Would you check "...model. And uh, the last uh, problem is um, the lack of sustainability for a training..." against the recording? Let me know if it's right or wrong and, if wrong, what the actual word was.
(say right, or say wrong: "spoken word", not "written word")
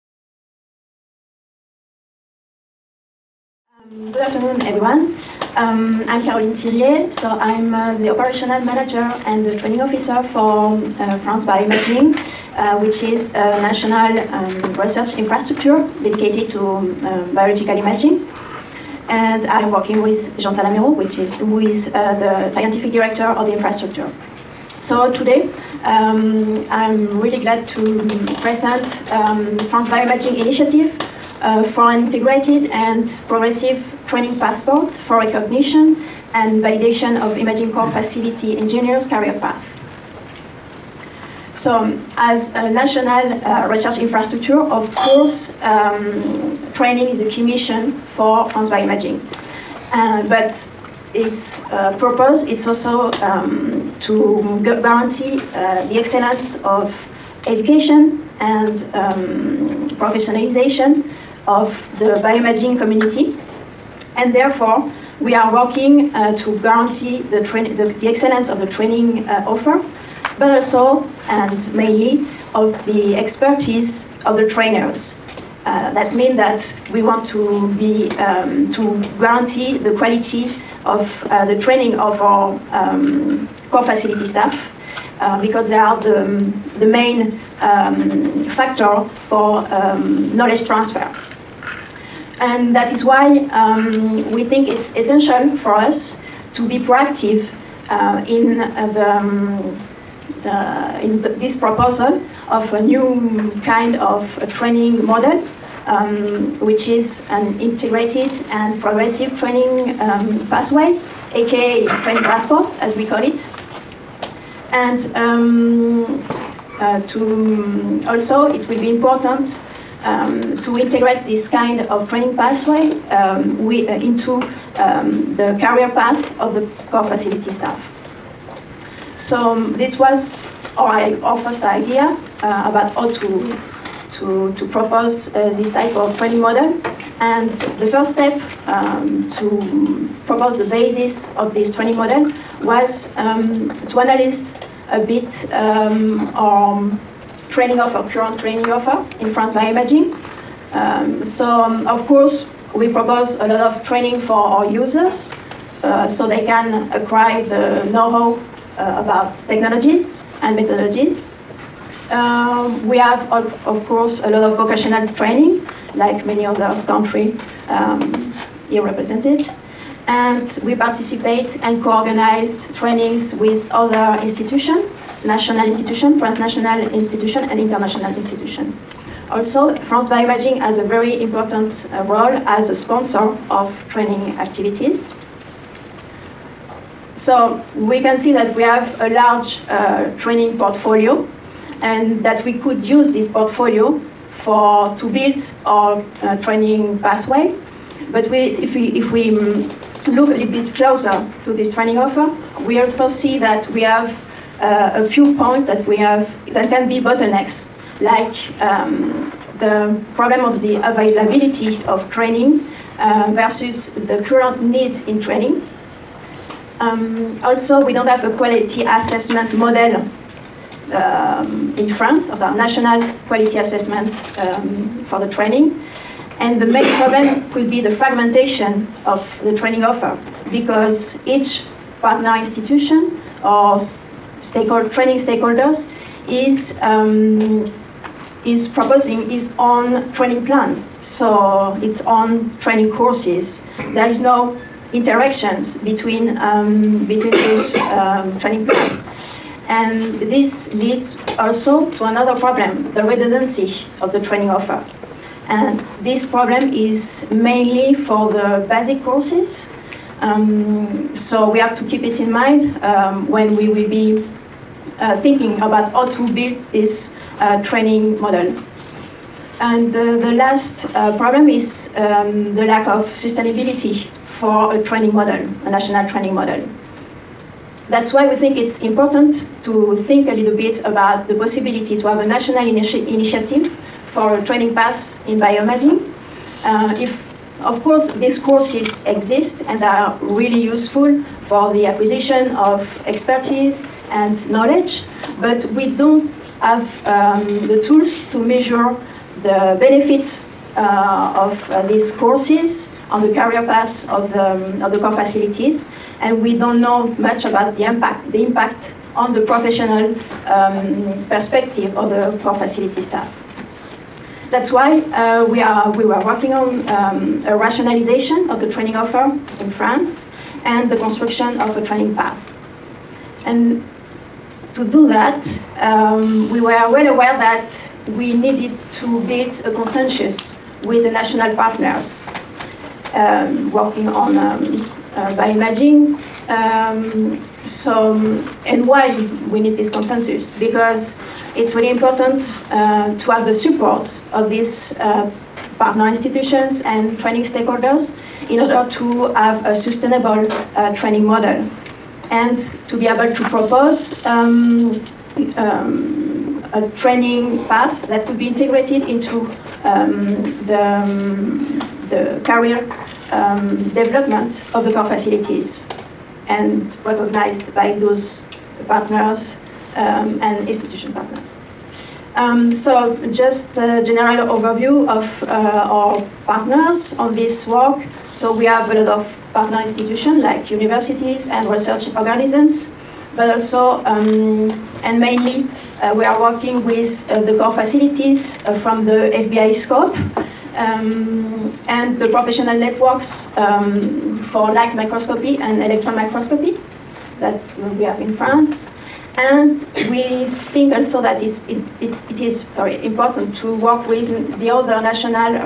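right.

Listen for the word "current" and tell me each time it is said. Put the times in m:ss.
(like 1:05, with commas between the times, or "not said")
2:28, 3:34.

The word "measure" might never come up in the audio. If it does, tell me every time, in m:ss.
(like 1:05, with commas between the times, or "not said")
4:58.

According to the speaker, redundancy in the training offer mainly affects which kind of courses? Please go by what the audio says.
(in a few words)
basic courses.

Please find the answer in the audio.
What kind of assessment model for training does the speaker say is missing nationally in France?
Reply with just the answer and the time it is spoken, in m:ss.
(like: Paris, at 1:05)
quality assessment model, at 3:38.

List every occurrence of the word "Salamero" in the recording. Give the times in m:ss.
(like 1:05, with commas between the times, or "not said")
0:20.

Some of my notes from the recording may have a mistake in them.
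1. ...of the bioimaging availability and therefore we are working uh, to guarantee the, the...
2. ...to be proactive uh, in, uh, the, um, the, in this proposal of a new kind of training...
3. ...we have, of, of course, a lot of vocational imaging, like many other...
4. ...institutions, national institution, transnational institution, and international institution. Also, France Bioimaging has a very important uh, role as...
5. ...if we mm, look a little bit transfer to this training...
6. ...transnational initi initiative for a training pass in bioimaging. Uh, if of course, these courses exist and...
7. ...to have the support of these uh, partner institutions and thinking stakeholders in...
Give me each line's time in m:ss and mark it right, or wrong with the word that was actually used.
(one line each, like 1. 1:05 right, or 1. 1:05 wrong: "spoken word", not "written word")
1. 1:01 wrong: "community", not "availability"
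2. 1:36 right
3. 2:42 wrong: "training", not "imaging"
4. 2:54 right
5. 3:18 wrong: "closer", not "transfer"
6. 4:42 wrong: "national", not "transnational"
7. 5:43 wrong: "training", not "thinking".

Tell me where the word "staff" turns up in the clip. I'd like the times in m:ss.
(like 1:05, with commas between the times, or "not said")
1:24, 2:07, 5:12.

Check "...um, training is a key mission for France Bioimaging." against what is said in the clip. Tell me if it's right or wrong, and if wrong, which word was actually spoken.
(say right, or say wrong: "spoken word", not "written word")
right.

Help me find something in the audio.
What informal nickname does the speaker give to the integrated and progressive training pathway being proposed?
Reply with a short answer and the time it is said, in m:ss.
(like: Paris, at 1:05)
train passport, at 1:52.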